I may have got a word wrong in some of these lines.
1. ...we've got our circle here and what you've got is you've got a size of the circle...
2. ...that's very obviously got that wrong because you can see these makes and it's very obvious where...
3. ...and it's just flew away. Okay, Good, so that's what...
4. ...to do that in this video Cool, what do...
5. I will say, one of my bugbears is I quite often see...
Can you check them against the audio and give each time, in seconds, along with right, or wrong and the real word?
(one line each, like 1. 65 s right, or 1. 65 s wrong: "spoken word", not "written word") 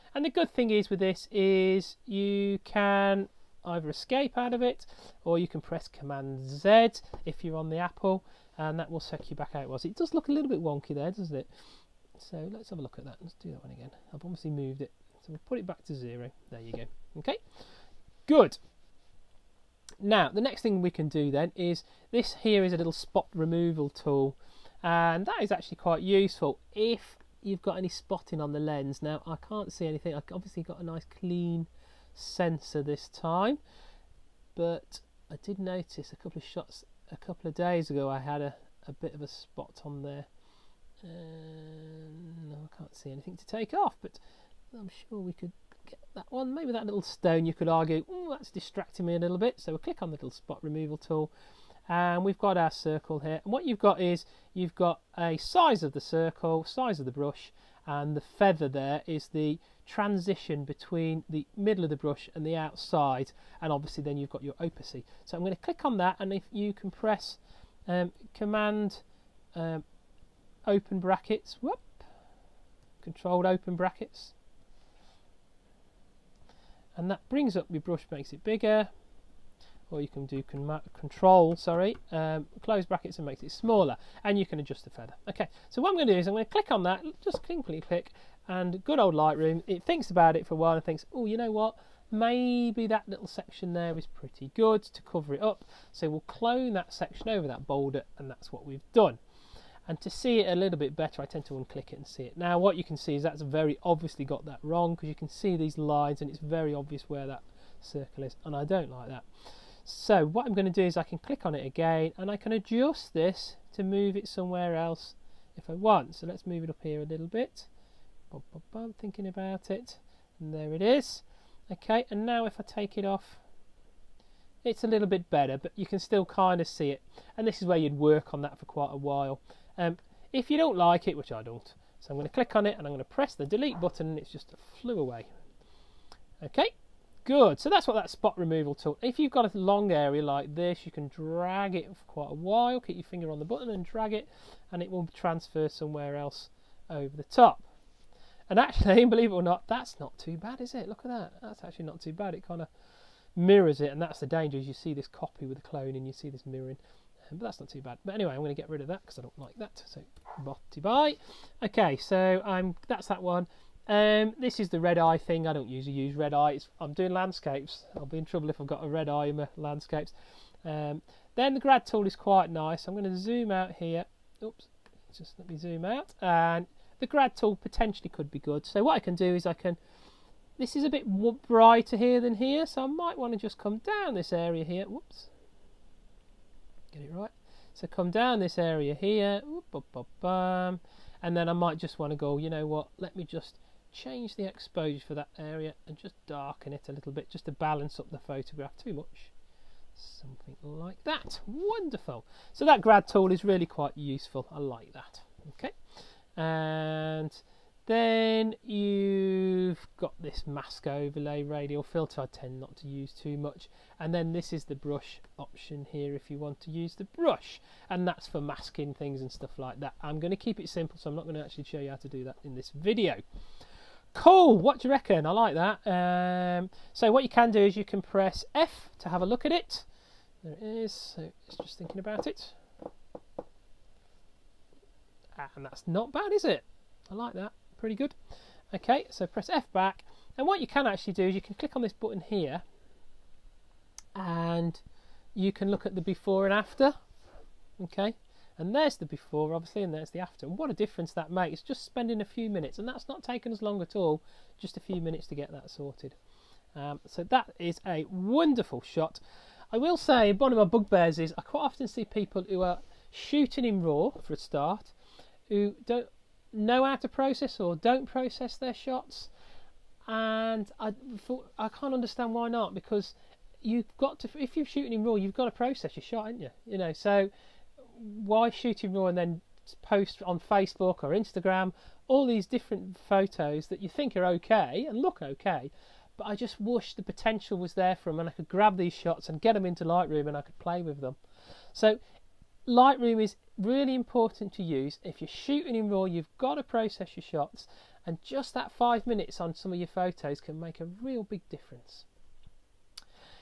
1. 52 s right
2. 103 s wrong: "lines", not "makes"
3. 134 s right
4. 221 s right
5. 259 s right.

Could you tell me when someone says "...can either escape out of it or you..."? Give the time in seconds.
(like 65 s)
2 s.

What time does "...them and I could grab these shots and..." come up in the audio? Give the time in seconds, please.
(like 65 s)
288 s.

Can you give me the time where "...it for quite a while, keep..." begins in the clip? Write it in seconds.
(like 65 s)
141 s.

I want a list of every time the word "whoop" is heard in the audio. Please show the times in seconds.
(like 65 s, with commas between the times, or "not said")
71 s, 184 s.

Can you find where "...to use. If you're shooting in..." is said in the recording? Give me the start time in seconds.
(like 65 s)
294 s.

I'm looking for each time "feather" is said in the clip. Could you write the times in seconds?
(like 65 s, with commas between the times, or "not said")
58 s, 84 s.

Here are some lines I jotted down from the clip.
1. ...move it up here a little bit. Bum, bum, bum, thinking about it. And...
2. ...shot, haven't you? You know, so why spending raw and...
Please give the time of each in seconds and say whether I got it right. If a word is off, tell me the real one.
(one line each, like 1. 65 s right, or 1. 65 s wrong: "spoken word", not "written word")
1. 116 s right
2. 276 s wrong: "shooting", not "spending".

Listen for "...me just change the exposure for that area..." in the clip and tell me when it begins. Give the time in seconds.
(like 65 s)
193 s.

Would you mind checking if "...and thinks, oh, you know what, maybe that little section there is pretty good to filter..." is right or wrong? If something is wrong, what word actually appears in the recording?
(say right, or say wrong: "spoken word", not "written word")
wrong: "cover", not "filter".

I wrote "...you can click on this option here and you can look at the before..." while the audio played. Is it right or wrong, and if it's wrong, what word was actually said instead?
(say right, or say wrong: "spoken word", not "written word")
wrong: "button", not "option".